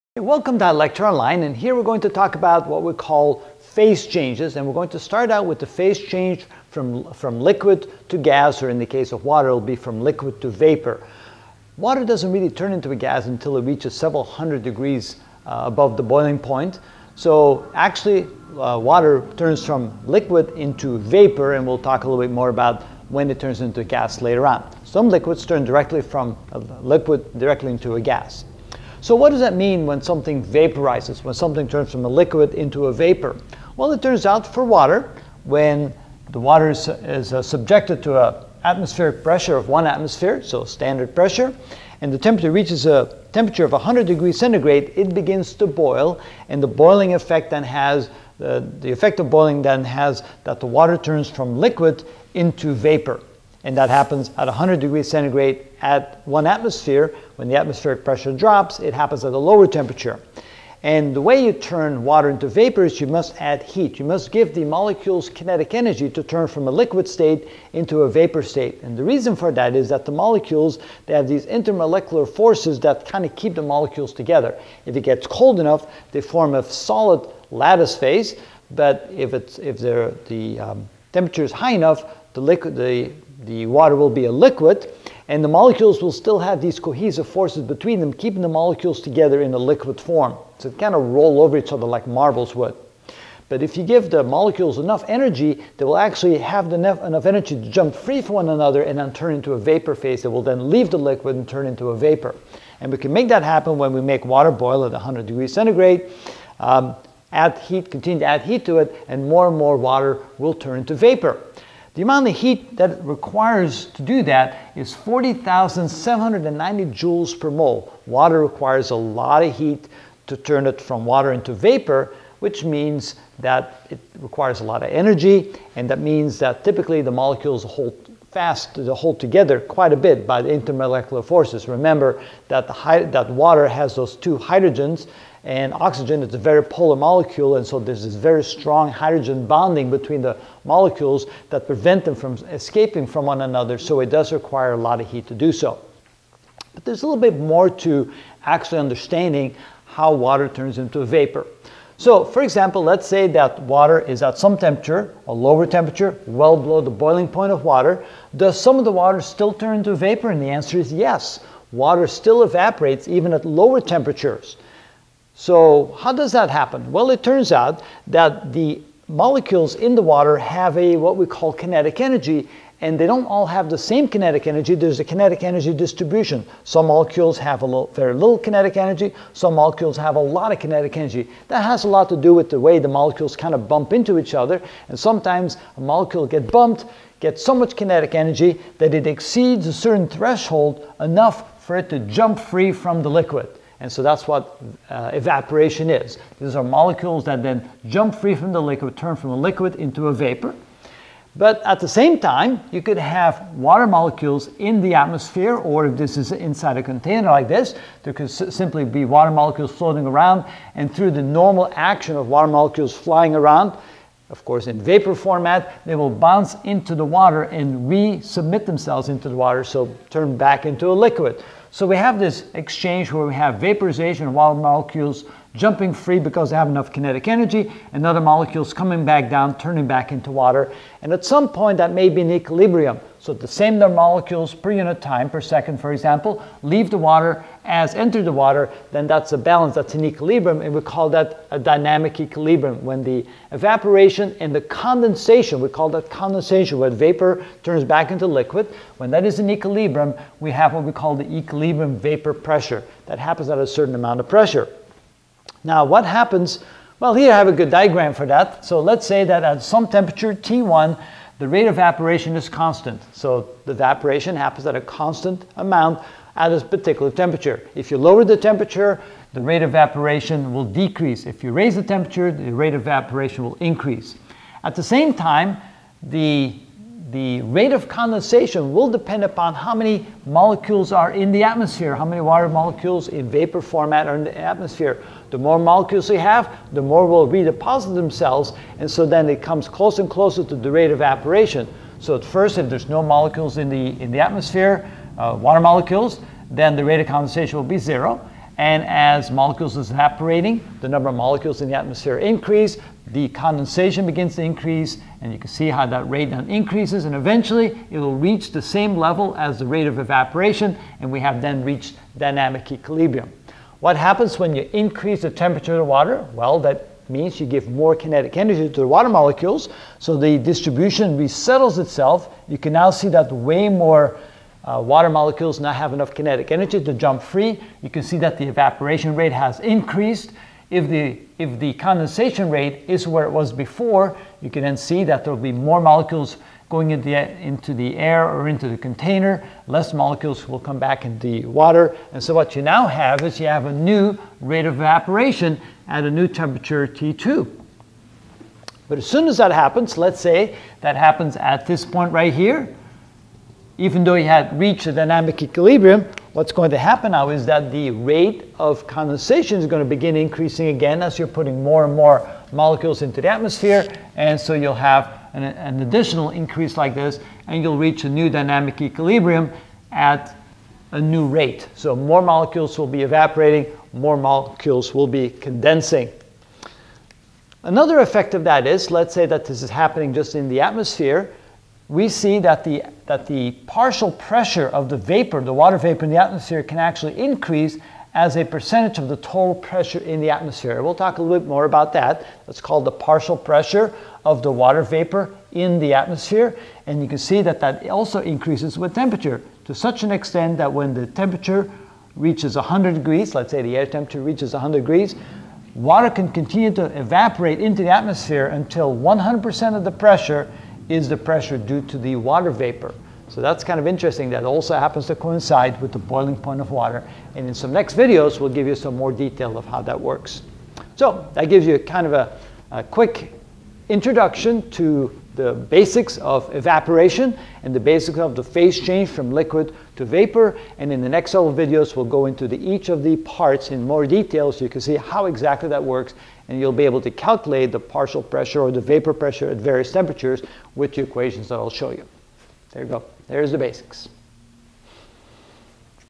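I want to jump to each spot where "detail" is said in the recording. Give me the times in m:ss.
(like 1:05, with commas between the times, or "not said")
6:59, 7:14.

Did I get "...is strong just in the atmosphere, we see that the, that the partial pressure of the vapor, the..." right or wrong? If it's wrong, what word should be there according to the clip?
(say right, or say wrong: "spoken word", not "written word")
wrong: "happening", not "strong".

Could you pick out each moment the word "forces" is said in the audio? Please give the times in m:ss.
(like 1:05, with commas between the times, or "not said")
1:12, 1:27, 2:11.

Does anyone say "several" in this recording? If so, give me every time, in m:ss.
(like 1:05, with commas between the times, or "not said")
0:13, 7:11.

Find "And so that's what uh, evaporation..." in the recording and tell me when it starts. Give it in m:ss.
3:13.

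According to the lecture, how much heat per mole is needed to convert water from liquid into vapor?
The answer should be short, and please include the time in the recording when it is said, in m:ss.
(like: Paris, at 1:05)
40,790 joules per mole, at 1:54.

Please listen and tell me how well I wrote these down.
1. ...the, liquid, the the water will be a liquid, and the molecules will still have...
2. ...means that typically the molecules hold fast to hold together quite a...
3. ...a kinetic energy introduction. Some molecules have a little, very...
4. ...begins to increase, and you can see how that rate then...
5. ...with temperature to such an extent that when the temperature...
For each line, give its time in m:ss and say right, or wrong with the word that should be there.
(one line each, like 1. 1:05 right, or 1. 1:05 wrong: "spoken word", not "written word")
1. 1:22 right
2. 2:05 right
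3. 2:54 wrong: "distribution", not "introduction"
4. 5:04 right
5. 6:38 right.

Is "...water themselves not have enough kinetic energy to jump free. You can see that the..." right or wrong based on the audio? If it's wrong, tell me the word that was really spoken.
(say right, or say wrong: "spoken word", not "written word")
wrong: "molecules", not "themselves".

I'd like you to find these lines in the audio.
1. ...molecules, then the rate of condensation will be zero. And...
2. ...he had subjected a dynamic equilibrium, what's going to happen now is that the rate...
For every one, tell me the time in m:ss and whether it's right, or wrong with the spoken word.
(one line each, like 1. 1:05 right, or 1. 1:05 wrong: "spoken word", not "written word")
1. 4:55 right
2. 5:54 wrong: "reached", not "subjected".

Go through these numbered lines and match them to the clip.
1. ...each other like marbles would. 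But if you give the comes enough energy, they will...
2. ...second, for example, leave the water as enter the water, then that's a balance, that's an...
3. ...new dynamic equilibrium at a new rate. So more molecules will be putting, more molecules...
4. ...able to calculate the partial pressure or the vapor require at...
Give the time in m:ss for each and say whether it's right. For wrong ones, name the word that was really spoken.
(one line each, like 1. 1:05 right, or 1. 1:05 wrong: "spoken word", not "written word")
1. 1:31 wrong: "molecules", not "comes"
2. 3:55 right
3. 6:08 wrong: "evaporating", not "putting"
4. 7:16 wrong: "pressure", not "require".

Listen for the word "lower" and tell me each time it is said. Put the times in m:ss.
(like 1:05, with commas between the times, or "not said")
0:59, 2:35, 2:43, 4:27.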